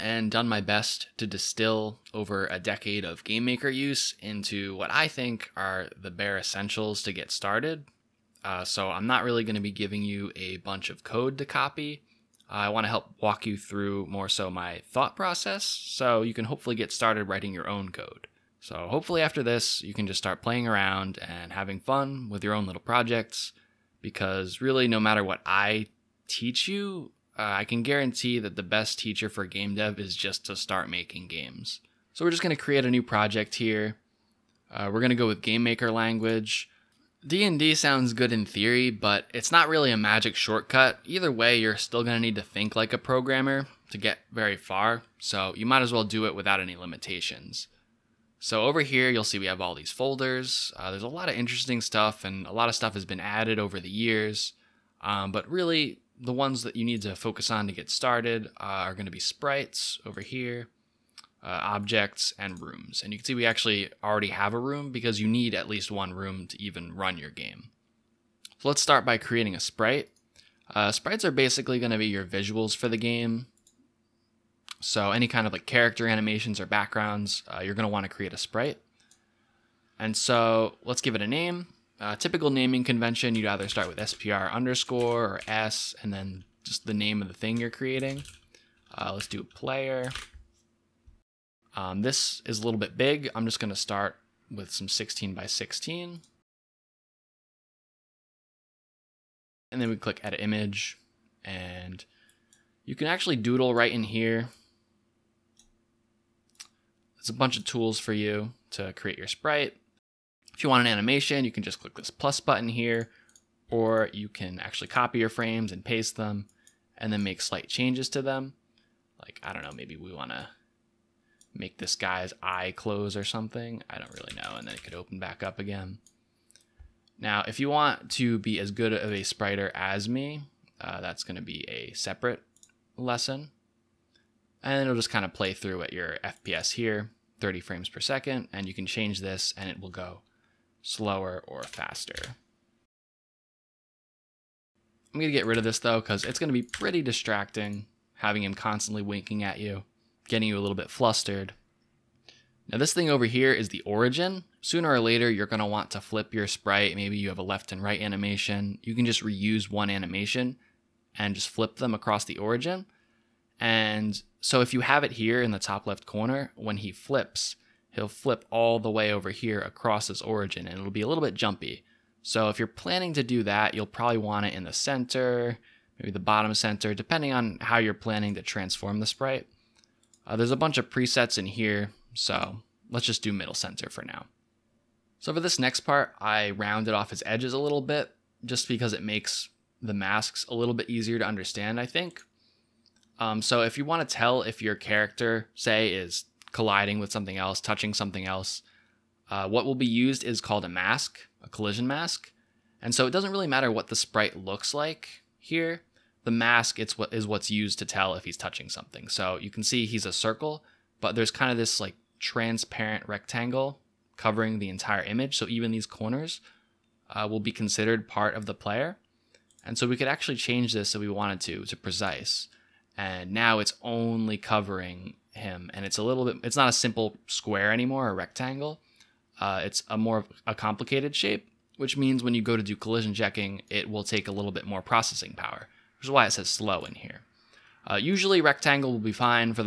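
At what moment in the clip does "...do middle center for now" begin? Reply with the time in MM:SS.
03:03.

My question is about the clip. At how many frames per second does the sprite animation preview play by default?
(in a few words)
30.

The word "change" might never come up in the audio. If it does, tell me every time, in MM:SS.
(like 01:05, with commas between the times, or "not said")
01:57, 02:18, 03:40.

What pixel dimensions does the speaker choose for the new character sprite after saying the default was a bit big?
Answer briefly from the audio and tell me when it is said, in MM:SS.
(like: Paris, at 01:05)
16 by 16, at 01:34.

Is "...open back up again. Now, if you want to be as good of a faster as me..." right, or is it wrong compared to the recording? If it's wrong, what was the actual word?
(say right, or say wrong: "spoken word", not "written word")
wrong: "spriter", not "faster".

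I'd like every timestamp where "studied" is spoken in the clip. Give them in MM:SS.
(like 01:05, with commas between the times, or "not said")
not said.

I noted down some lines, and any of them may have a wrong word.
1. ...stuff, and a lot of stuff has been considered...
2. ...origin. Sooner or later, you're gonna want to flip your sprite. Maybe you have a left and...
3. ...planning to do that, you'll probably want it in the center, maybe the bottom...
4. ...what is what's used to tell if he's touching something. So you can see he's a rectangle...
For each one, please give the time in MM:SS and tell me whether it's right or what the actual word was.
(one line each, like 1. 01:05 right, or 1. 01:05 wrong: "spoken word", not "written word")
1. 00:51 wrong: "added", not "considered"
2. 02:33 right
3. 02:52 right
4. 03:26 wrong: "circle", not "rectangle".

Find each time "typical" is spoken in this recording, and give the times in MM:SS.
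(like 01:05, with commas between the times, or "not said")
01:22.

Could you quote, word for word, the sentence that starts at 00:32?
So, we're just going to create a new project here.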